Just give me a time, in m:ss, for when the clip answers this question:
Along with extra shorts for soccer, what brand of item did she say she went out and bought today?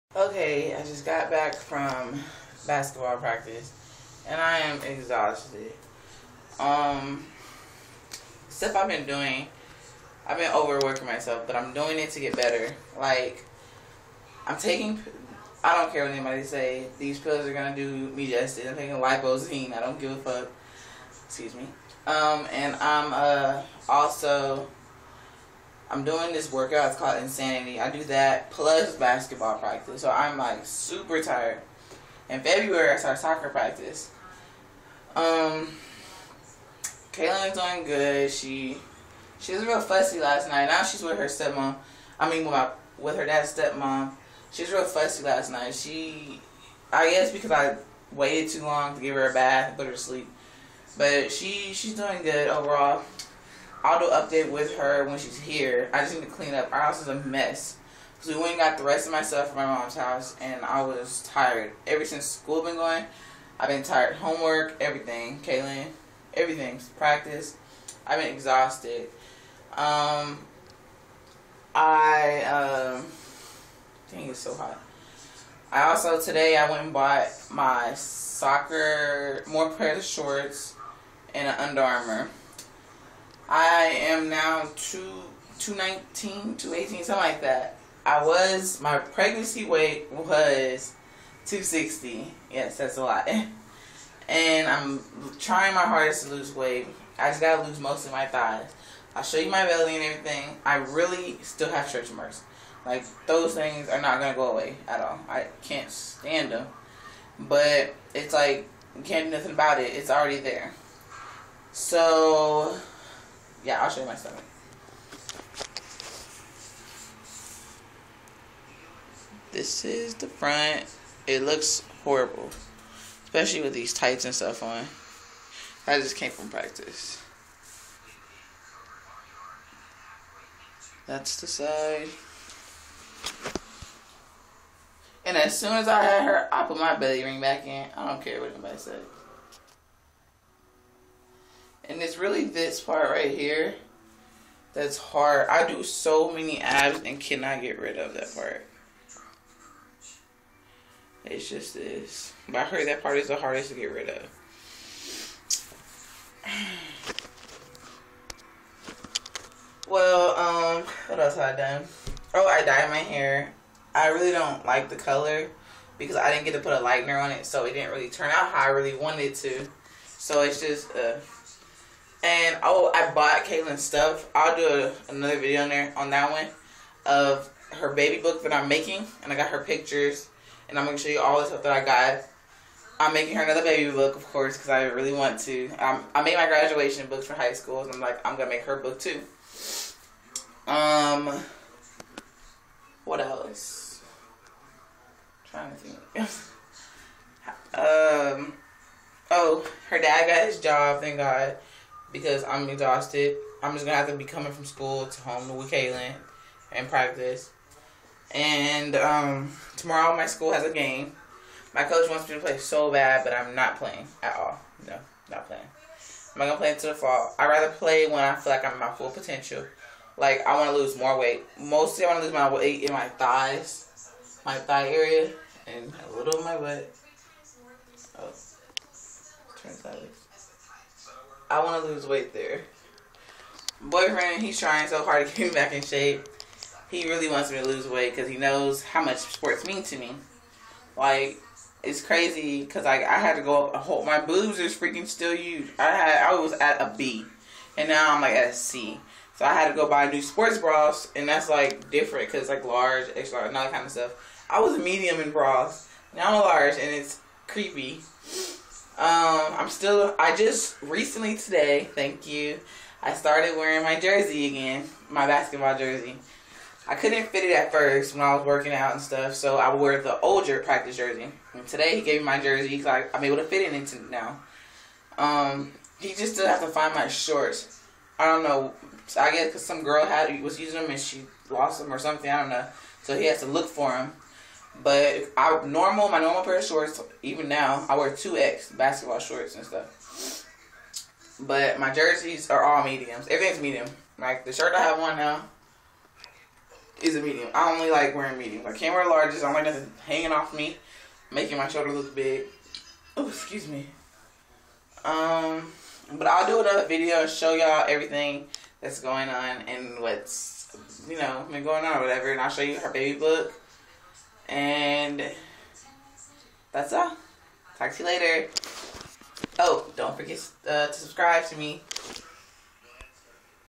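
1:21.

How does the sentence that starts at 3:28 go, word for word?
And um, tomorrow my school has a game.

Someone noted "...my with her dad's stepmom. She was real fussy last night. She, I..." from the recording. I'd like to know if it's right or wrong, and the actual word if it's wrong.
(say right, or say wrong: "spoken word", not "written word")
right.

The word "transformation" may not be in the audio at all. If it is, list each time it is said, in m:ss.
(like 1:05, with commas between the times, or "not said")
not said.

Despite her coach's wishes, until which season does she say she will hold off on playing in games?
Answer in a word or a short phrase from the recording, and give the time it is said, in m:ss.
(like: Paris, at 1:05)
The fall, at 3:36.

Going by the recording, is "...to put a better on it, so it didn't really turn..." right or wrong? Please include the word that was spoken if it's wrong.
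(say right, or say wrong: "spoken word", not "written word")
wrong: "lightener", not "better".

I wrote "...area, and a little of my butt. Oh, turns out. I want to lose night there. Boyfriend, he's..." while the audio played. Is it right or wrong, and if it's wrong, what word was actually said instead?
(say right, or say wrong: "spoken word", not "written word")
wrong: "weight", not "night".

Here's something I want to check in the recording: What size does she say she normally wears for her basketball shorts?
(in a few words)
2X.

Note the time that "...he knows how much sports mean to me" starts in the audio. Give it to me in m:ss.
3:58.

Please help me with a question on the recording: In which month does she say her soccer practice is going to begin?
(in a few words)
February.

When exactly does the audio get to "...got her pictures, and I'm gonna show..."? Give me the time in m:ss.
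2:59.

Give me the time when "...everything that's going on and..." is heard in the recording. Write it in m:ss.
5:07.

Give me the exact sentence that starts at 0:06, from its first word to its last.
Um stuff I've been doing, I've been overworking myself, but I'm doing it to get better.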